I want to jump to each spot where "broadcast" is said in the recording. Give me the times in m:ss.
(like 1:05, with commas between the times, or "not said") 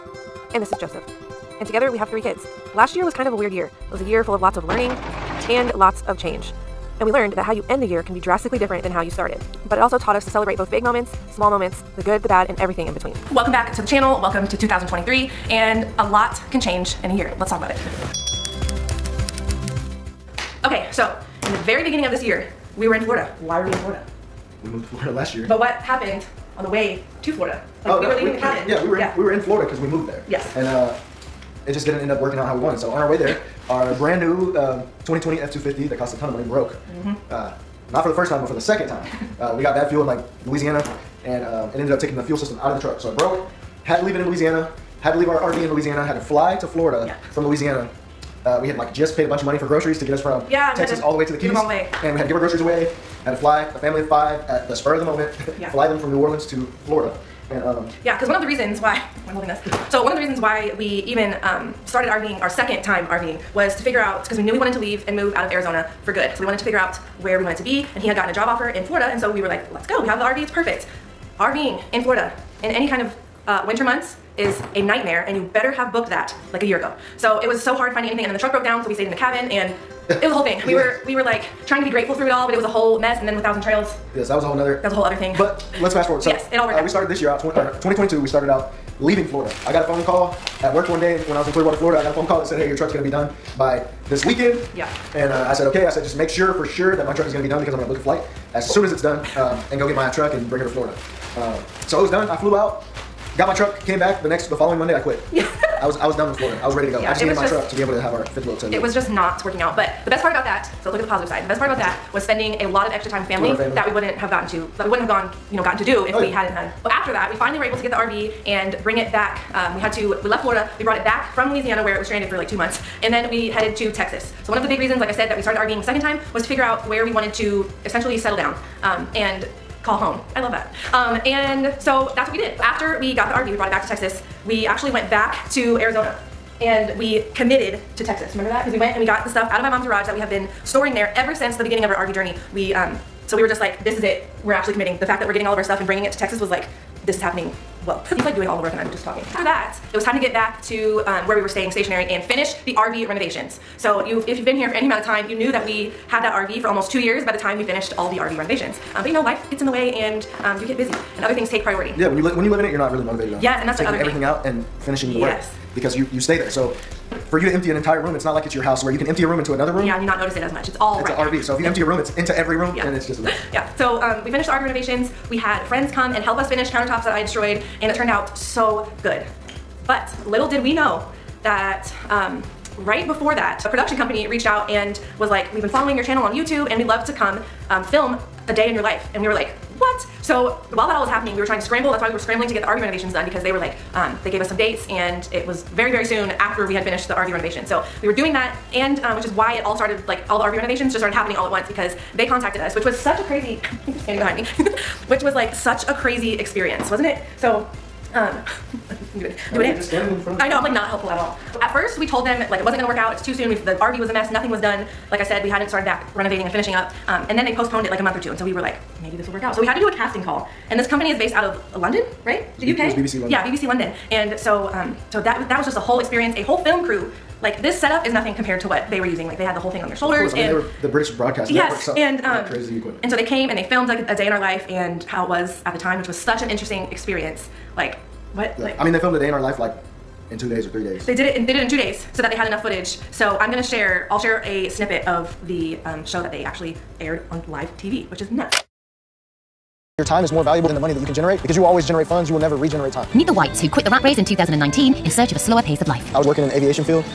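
3:51.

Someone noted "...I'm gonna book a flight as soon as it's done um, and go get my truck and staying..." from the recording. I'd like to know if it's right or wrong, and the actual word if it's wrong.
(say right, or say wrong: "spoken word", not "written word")
wrong: "bring", not "staying".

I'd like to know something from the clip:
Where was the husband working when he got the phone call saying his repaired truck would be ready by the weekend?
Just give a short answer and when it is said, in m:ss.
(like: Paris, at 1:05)
Clearwater, Florida, at 1:31.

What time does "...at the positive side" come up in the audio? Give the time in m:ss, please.
1:50.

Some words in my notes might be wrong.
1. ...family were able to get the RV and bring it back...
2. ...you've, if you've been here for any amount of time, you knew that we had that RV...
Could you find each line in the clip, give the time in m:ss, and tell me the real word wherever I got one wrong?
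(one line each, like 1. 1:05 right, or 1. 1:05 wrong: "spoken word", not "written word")
1. 1:57 wrong: "finally", not "family"
2. 2:34 right.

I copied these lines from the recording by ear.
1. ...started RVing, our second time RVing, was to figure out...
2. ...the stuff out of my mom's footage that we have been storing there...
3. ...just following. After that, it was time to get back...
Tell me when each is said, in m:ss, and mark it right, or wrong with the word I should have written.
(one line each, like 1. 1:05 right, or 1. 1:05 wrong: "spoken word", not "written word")
1. 1:01 right
2. 2:19 wrong: "garage", not "footage"
3. 2:28 wrong: "talking", not "following".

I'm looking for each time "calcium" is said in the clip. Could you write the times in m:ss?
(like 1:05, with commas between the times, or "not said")
not said.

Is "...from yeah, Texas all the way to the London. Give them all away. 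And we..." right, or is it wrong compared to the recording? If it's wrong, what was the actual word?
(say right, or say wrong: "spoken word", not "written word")
wrong: "Keys", not "London".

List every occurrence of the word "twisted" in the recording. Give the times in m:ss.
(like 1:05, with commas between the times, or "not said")
not said.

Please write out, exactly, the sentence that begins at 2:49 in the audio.
Yeah, and you not notice it as much.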